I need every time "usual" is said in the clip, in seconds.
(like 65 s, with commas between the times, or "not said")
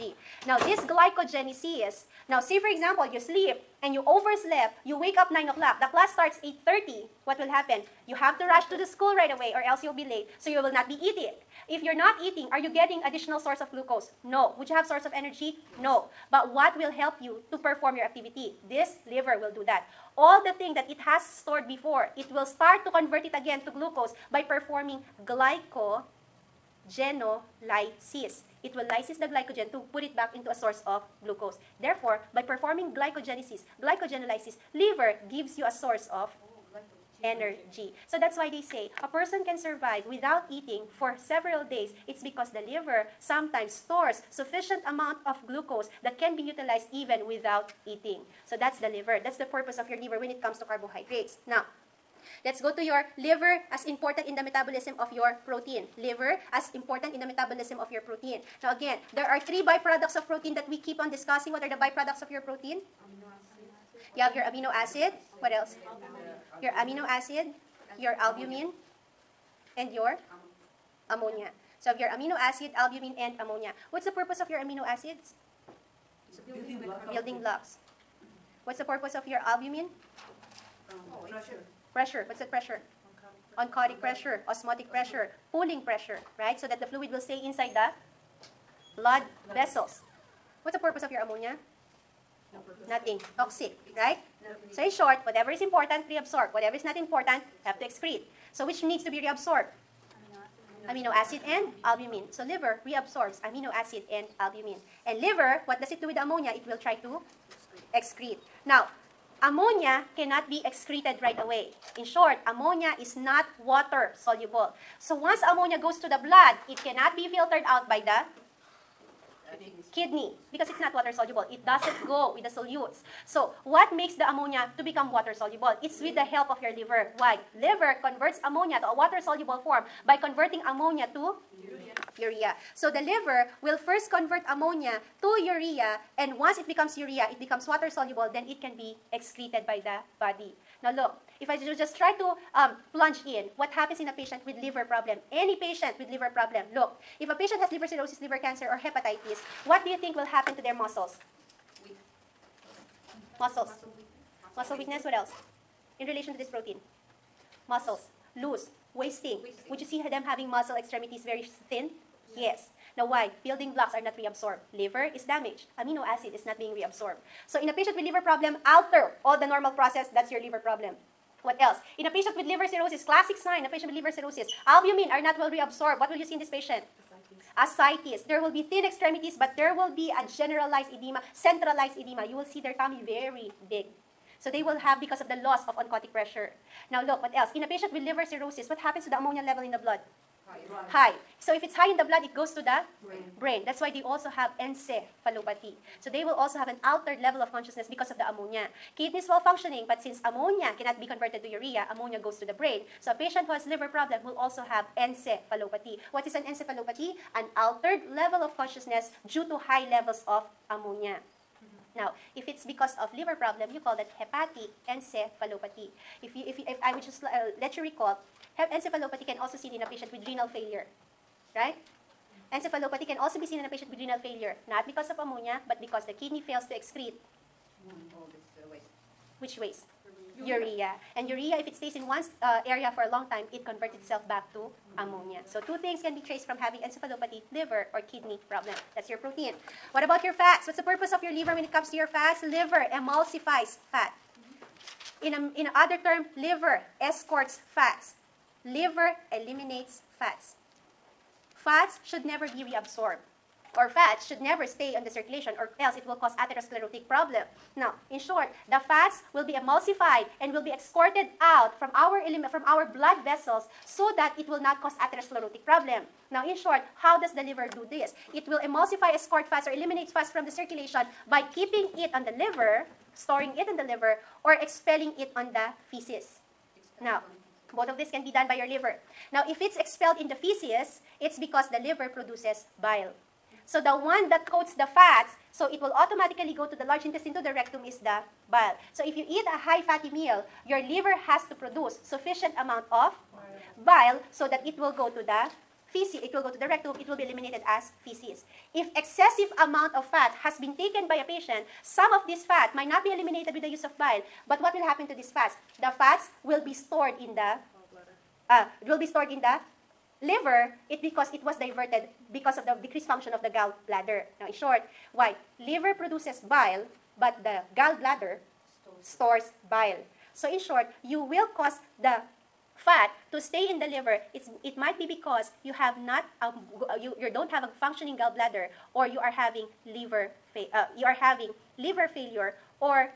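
not said.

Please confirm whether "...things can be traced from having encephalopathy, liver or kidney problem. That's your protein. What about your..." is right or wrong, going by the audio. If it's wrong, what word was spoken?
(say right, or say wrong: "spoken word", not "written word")
right.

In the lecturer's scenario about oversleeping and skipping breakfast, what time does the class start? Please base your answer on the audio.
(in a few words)
8:30.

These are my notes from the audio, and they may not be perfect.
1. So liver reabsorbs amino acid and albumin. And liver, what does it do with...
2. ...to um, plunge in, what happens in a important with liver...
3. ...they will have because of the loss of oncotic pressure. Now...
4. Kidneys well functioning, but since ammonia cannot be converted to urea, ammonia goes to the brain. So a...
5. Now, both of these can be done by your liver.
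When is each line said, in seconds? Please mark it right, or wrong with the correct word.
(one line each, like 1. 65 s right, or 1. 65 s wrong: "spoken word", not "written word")
1. 102 s right
2. 142 s wrong: "patient", not "important"
3. 184 s right
4. 198 s right
5. 277 s right.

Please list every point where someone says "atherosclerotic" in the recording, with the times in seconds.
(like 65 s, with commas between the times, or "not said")
256 s, 264 s.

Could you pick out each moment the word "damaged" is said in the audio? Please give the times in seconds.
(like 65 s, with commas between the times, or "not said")
165 s.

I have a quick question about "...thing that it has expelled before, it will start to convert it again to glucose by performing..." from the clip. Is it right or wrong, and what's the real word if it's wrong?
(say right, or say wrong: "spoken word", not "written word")
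wrong: "stored", not "expelled".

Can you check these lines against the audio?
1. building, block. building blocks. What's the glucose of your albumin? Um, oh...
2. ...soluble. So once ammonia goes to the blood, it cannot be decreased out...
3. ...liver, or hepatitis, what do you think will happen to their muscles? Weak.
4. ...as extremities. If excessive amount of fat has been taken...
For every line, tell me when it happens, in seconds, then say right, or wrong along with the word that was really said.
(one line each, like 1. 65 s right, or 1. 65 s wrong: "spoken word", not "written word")
1. 76 s wrong: "purpose", not "glucose"
2. 114 s wrong: "filtered", not "decreased"
3. 148 s wrong: "cancer", not "liver"
4. 297 s wrong: "feces", not "extremities".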